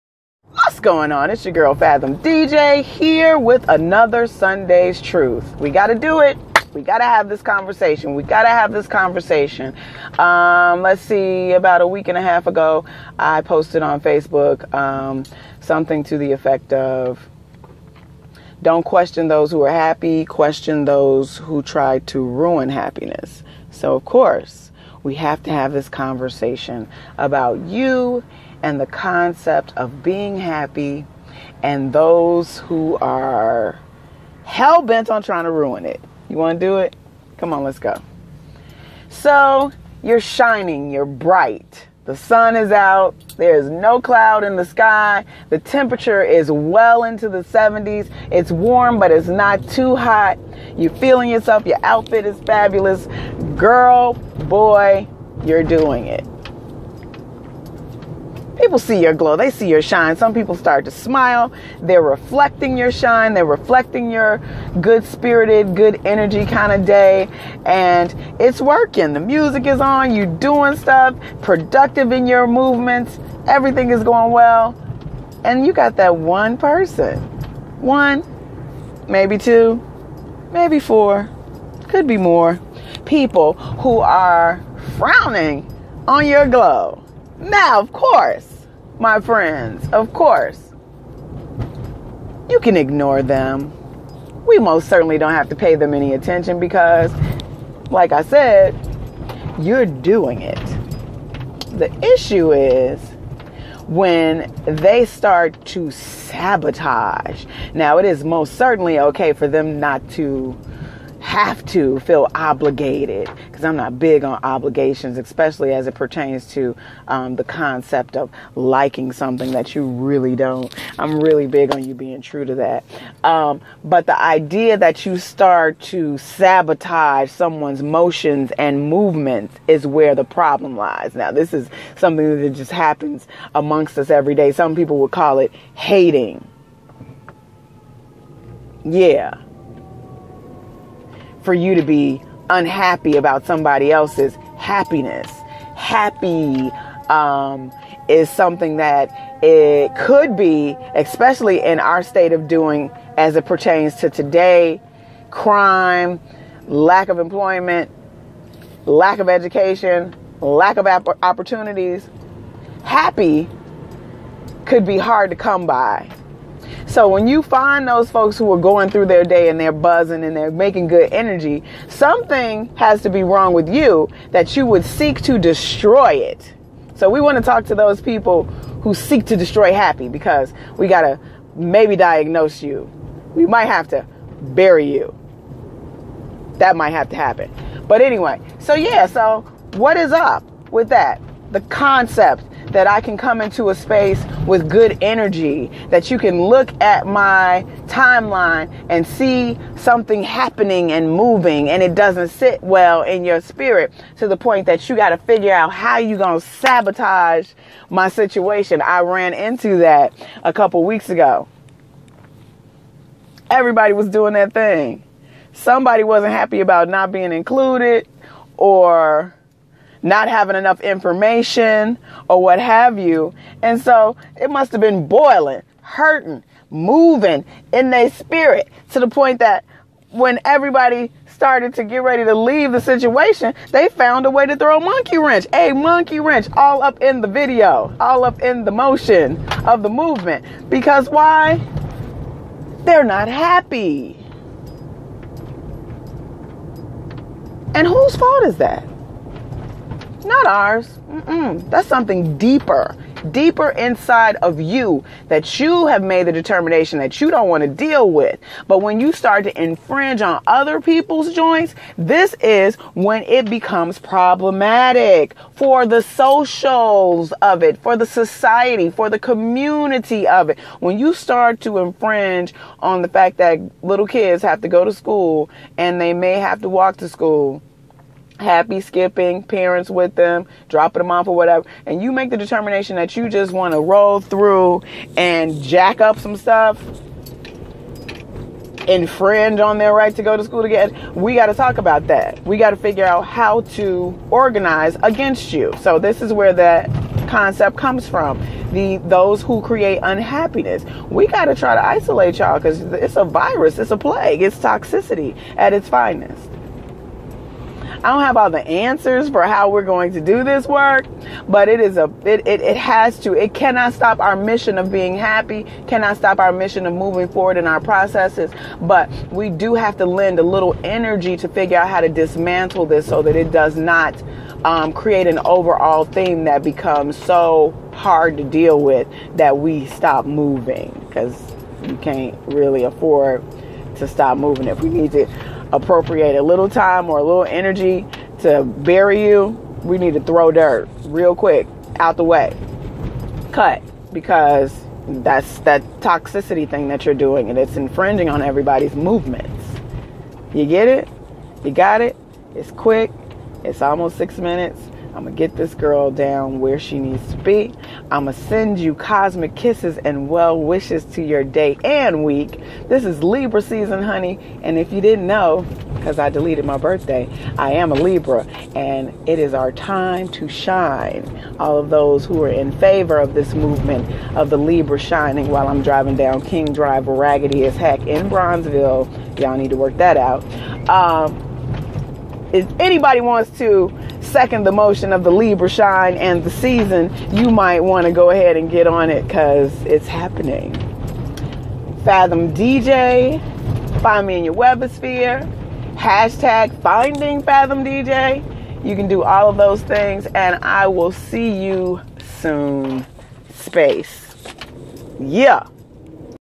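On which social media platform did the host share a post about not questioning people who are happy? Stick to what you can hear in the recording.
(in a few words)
Facebook.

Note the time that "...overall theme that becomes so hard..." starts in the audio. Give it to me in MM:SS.
05:25.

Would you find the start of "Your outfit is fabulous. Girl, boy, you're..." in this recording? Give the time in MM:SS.
00:51.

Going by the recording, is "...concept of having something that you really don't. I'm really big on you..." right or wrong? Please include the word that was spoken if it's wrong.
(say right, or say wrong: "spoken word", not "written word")
wrong: "liking", not "having".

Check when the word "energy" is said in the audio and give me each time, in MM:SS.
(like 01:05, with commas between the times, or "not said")
01:06, 02:51, 03:15, 05:20, 05:37.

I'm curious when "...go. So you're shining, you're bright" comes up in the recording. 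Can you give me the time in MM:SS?
00:37.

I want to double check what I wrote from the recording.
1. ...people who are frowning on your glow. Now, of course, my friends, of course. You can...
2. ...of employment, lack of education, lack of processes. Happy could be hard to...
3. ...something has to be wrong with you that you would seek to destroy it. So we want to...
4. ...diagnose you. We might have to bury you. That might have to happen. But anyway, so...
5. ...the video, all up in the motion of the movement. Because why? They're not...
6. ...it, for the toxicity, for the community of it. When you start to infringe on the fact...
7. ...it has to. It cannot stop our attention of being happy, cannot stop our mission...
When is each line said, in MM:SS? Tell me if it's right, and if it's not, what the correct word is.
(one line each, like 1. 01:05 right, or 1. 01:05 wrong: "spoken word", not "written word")
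1. 01:23 right
2. 02:37 wrong: "opportunities", not "processes"
3. 02:51 right
4. 03:01 right
5. 03:57 right
6. 04:27 wrong: "society", not "toxicity"
7. 05:12 wrong: "mission", not "attention".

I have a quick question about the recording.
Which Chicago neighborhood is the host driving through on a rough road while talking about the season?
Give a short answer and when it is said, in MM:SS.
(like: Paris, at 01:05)
Bronzeville, at 06:18.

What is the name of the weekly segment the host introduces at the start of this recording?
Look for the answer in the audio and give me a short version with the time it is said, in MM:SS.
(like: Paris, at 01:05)
Sunday's Truth, at 00:04.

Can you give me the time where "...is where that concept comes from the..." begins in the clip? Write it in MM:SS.
04:56.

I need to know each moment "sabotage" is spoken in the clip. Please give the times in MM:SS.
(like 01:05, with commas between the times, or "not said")
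01:45, 02:06, 03:26.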